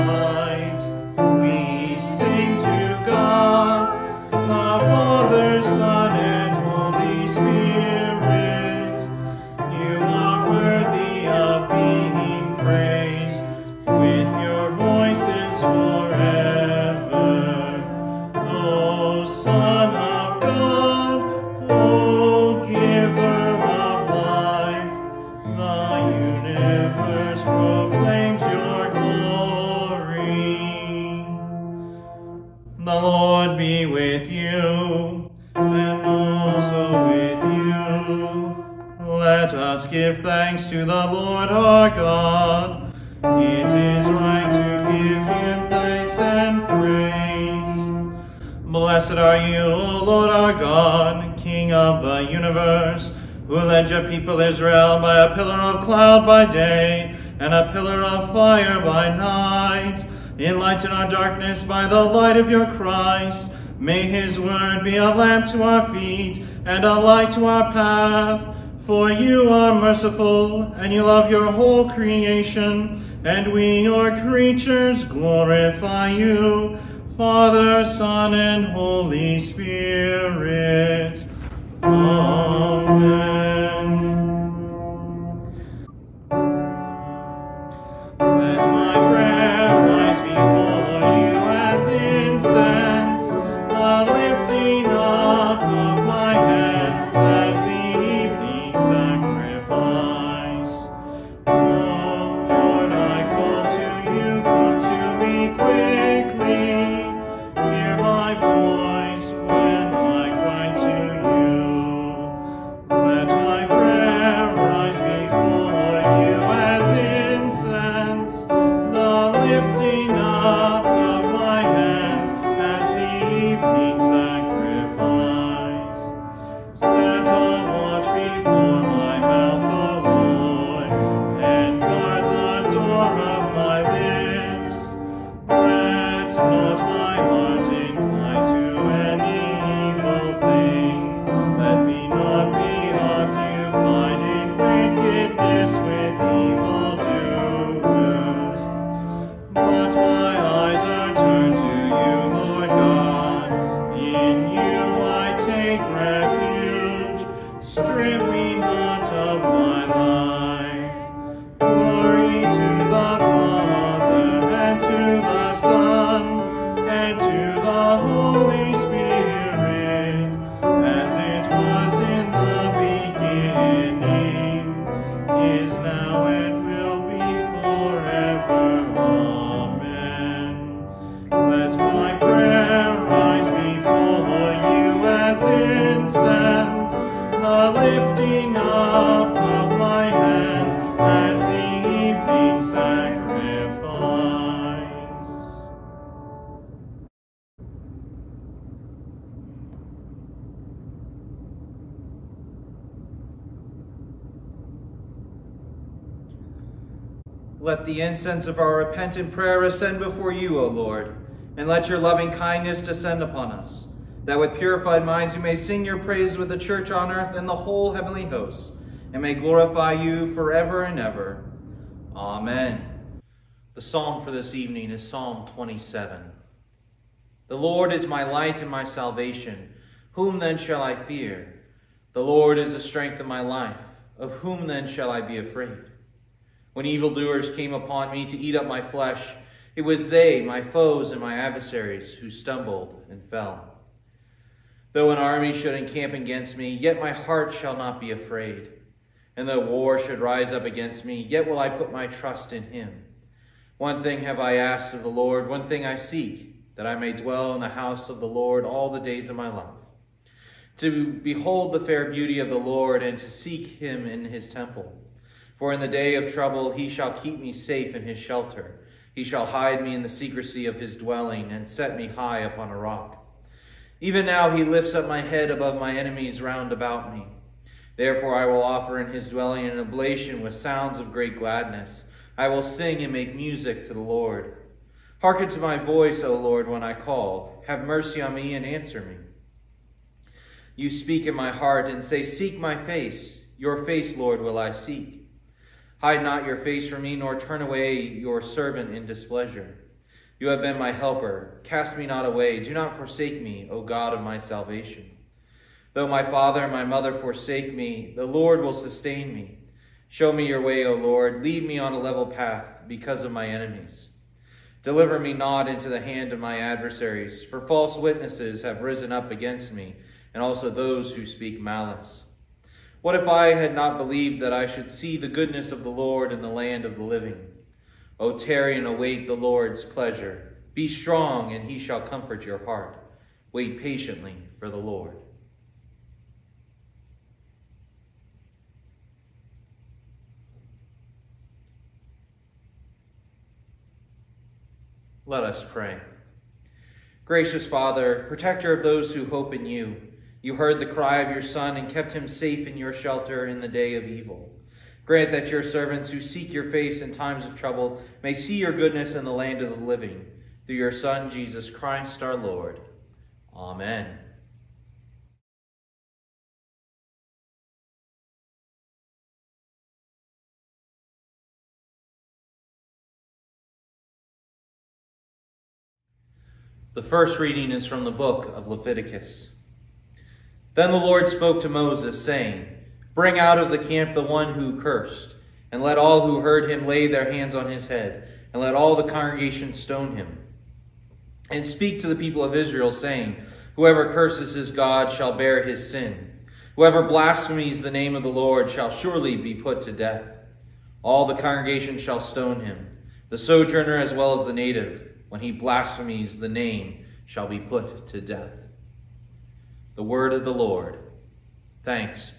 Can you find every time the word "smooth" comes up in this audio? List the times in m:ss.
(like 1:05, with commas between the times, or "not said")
not said.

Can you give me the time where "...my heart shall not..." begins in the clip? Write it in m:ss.
4:06.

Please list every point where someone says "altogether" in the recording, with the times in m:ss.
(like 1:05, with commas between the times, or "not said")
not said.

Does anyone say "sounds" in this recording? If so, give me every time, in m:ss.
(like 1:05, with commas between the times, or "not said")
4:40.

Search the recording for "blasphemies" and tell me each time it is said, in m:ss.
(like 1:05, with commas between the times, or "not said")
6:37, 6:45.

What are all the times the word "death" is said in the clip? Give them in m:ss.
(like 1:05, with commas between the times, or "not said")
6:39, 6:48.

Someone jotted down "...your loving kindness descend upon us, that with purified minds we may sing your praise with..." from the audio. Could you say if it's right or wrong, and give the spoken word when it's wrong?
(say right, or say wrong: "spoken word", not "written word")
right.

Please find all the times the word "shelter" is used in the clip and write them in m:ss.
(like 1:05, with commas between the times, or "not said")
4:28, 5:52.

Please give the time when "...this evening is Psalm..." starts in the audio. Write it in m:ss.
3:44.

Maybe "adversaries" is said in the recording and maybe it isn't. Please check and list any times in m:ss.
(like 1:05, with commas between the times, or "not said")
4:01, 5:16.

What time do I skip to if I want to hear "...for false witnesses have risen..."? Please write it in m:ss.
5:17.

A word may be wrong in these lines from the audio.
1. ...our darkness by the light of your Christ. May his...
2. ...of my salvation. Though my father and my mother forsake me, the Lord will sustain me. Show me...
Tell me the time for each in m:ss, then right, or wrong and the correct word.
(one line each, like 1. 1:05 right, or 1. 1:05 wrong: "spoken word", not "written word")
1. 1:00 right
2. 5:04 right.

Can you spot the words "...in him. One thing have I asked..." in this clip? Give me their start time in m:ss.
4:12.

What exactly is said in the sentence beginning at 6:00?
Through your Son, Jesus Christ our Lord.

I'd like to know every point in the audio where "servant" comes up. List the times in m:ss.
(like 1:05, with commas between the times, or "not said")
4:58, 5:55.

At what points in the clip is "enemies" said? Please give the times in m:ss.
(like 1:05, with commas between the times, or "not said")
4:35, 5:13.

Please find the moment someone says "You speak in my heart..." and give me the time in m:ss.
4:50.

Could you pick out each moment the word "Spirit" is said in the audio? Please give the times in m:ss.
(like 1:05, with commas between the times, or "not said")
1:19.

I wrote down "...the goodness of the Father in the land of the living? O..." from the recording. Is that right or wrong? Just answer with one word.
wrong.